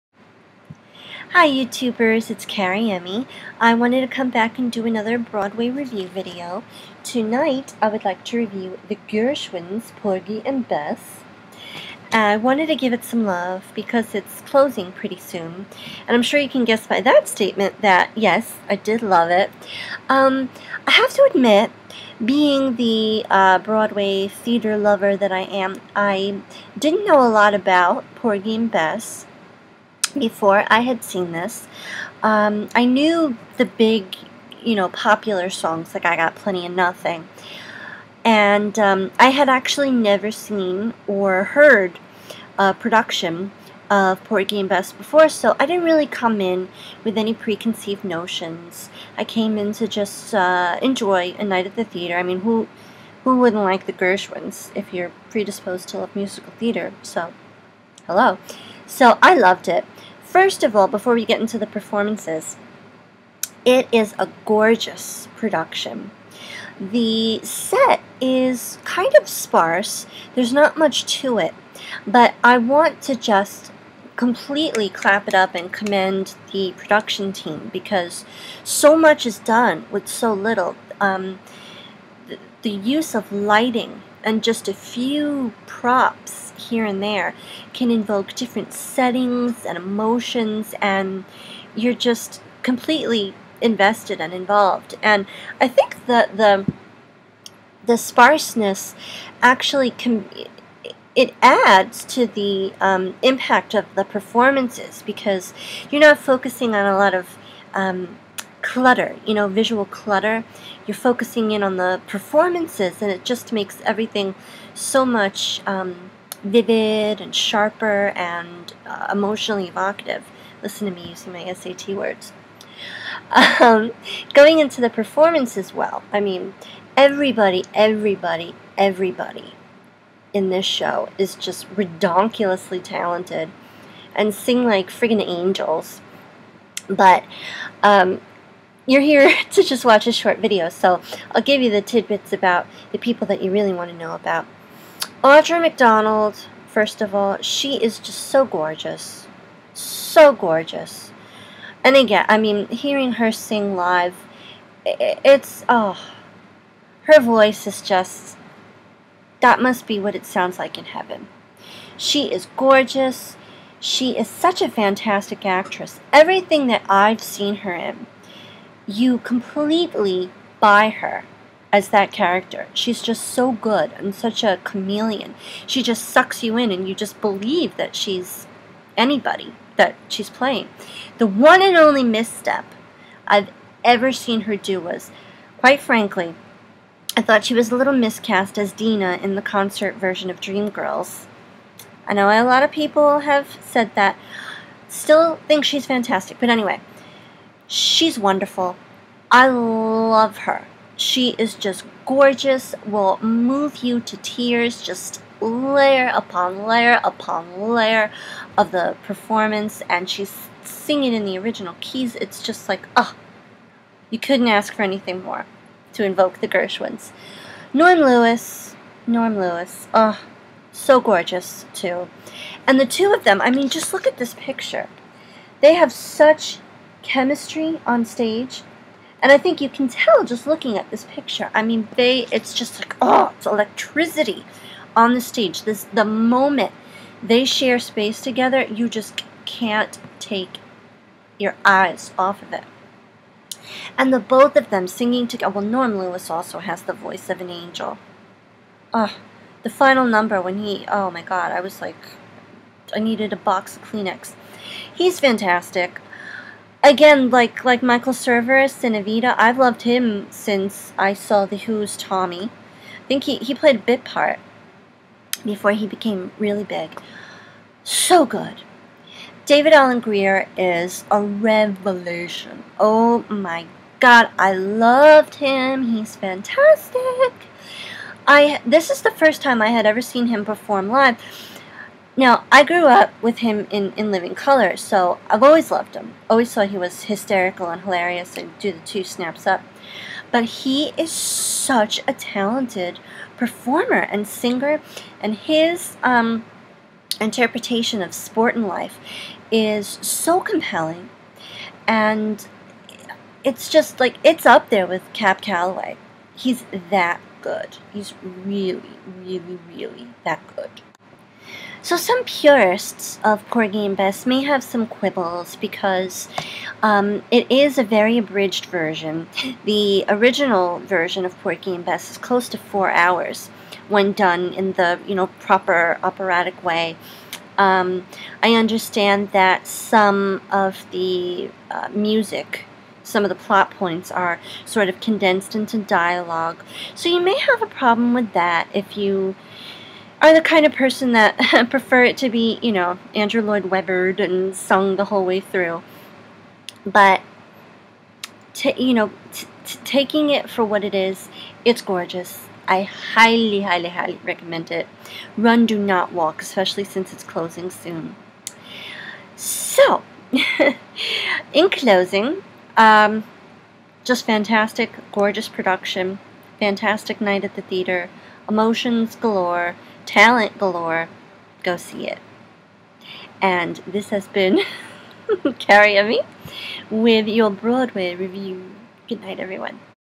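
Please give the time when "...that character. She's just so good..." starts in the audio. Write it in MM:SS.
02:51.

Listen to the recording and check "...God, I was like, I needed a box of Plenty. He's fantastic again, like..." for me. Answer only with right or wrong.
wrong.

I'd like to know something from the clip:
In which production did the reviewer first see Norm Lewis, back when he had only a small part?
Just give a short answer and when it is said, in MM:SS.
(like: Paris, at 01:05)
The Who's Tommy, at 04:21.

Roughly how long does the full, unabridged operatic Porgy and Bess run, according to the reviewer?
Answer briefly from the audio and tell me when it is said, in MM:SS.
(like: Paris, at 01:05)
close to 4 hours, at 05:22.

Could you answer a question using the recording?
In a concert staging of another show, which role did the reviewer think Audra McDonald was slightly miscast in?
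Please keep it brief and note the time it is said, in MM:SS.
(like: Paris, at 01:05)
Deena, at 03:08.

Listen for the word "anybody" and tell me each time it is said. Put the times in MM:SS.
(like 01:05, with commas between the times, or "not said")
02:58.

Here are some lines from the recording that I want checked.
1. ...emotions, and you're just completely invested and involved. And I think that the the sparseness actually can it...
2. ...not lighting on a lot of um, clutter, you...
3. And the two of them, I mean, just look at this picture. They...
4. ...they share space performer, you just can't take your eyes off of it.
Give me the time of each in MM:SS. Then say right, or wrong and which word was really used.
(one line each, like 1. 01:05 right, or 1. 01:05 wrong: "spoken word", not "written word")
1. 01:29 right
2. 01:45 wrong: "focusing", not "lighting"
3. 03:42 right
4. 03:57 wrong: "together", not "performer".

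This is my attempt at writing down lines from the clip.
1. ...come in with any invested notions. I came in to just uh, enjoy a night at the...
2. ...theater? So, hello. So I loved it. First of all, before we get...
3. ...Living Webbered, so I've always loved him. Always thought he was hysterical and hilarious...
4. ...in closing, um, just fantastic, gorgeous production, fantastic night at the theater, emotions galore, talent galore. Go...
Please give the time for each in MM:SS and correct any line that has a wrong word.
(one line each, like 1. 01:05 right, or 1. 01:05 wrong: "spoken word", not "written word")
1. 00:46 wrong: "preconceived", not "invested"
2. 00:56 right
3. 04:44 wrong: "Color", not "Webbered"
4. 06:01 right.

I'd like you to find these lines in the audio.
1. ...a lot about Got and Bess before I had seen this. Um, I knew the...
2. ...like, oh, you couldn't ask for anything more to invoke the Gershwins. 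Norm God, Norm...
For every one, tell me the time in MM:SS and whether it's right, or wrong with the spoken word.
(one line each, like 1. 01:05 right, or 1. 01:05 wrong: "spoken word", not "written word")
1. 00:27 wrong: "Porgy", not "Got"
2. 03:32 wrong: "Lewis", not "God".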